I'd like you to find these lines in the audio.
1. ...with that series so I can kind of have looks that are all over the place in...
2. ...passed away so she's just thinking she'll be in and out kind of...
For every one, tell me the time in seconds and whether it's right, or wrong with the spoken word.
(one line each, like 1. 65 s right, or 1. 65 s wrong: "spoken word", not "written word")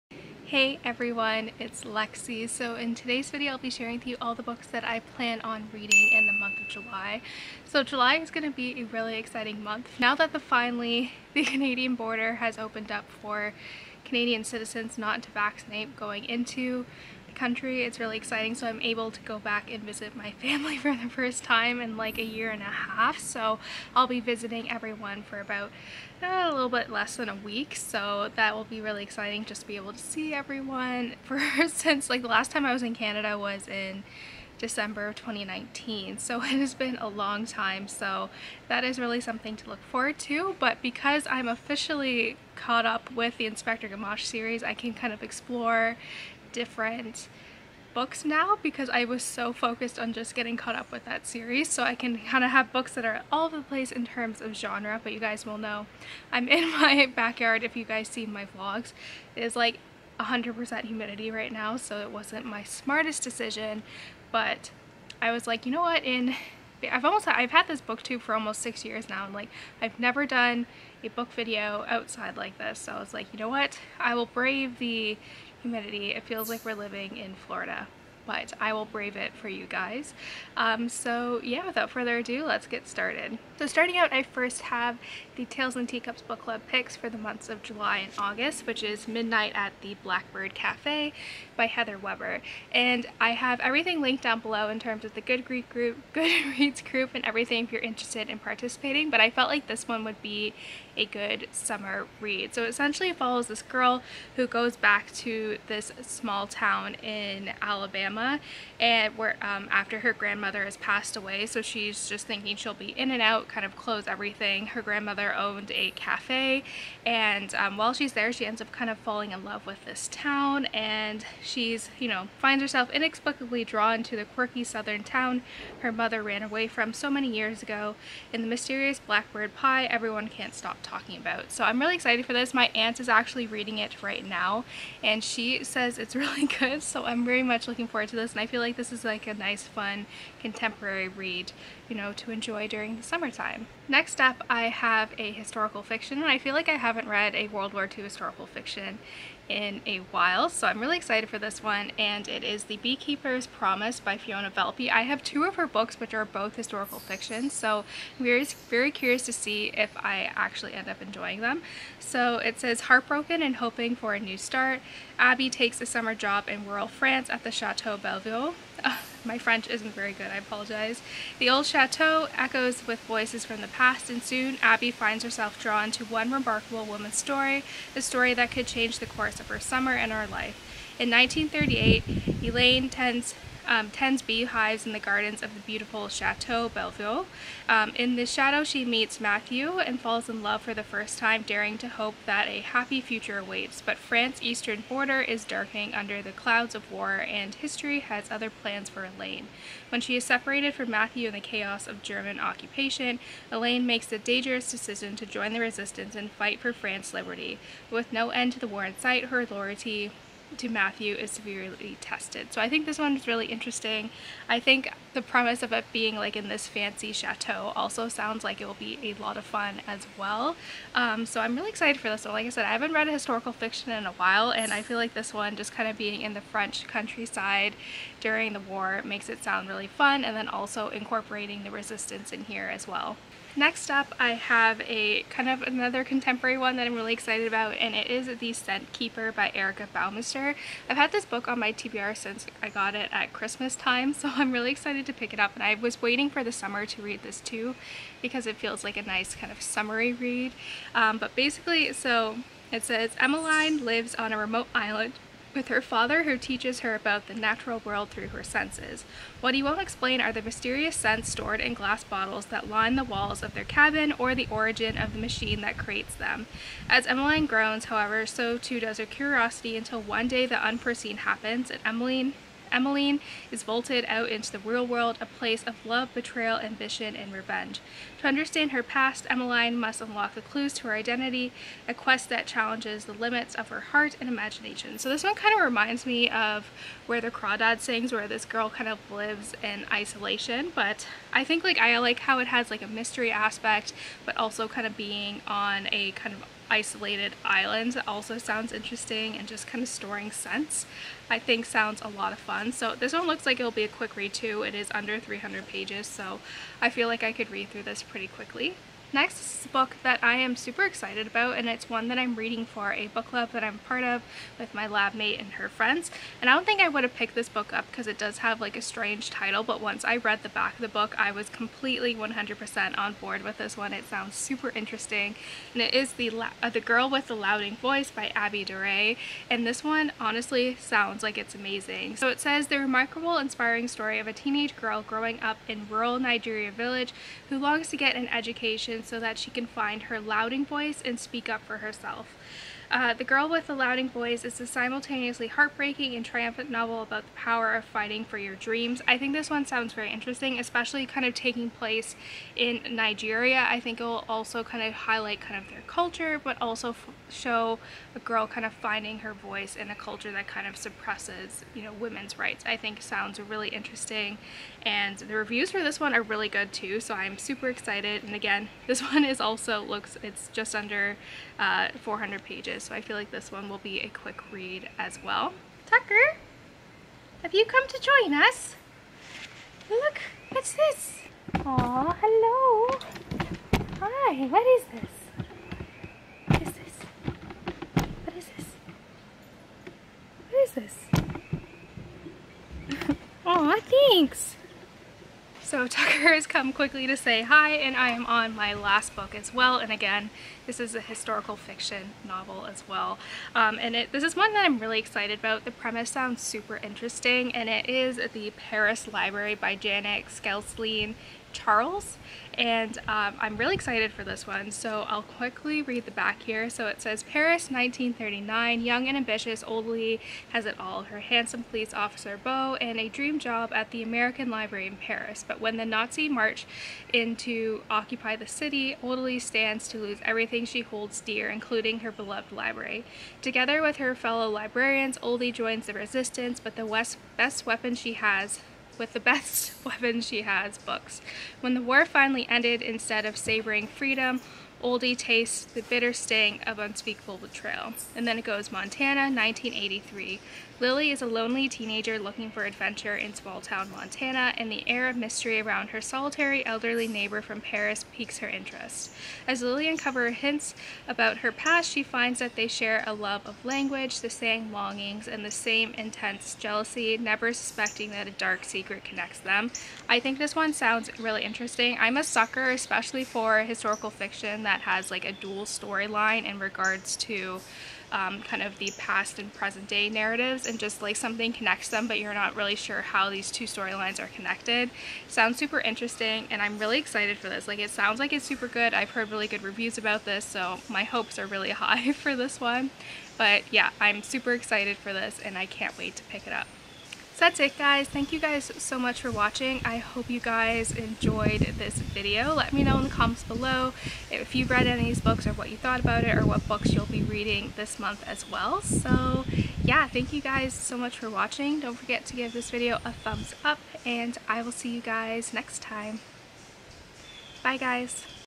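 1. 50 s wrong: "books", not "looks"
2. 110 s right.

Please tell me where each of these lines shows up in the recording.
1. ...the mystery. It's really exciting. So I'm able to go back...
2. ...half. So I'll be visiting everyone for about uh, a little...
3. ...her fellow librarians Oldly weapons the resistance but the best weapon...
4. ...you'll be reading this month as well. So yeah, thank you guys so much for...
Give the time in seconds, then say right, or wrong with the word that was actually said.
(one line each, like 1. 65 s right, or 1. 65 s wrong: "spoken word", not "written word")
1. 17 s wrong: "country", not "mystery"
2. 22 s right
3. 433 s wrong: "joins", not "weapons"
4. 506 s right.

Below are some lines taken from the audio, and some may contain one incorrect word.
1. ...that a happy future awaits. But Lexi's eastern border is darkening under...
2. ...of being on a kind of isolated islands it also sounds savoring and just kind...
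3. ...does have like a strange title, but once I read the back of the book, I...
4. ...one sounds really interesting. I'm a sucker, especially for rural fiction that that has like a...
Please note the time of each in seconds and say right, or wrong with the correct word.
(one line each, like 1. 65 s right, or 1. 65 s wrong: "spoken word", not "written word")
1. 192 s wrong: "France", not "Lexi"
2. 294 s wrong: "interesting", not "savoring"
3. 318 s right
4. 470 s wrong: "historical", not "rural".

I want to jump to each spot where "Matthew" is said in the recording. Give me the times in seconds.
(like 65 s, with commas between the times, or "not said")
189 s, 200 s, 210 s.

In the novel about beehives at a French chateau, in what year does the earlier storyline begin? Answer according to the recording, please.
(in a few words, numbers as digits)
1938.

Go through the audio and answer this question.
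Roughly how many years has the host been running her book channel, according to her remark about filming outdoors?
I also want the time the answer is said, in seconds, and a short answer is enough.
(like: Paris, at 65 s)
almost 6 years, at 68 s.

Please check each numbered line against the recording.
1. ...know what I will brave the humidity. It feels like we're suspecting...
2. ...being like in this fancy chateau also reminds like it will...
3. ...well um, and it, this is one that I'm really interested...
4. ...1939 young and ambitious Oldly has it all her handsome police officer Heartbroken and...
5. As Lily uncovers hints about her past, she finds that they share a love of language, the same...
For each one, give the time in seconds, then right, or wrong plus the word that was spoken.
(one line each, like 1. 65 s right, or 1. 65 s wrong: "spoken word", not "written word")
1. 73 s wrong: "living", not "suspecting"
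2. 215 s wrong: "sounds", not "reminds"
3. 402 s wrong: "excited", not "interested"
4. 417 s wrong: "Beau", not "Heartbroken"
5. 459 s right.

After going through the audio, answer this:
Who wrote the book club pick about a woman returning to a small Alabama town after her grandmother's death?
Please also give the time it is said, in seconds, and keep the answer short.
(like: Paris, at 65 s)
Heather Webber, at 91 s.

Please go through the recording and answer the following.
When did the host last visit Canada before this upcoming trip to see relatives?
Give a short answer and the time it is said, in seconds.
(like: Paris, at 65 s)
December 2019, at 34 s.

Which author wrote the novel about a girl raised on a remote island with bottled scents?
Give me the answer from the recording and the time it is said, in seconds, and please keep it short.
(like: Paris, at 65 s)
Erica Bauermeister, at 239 s.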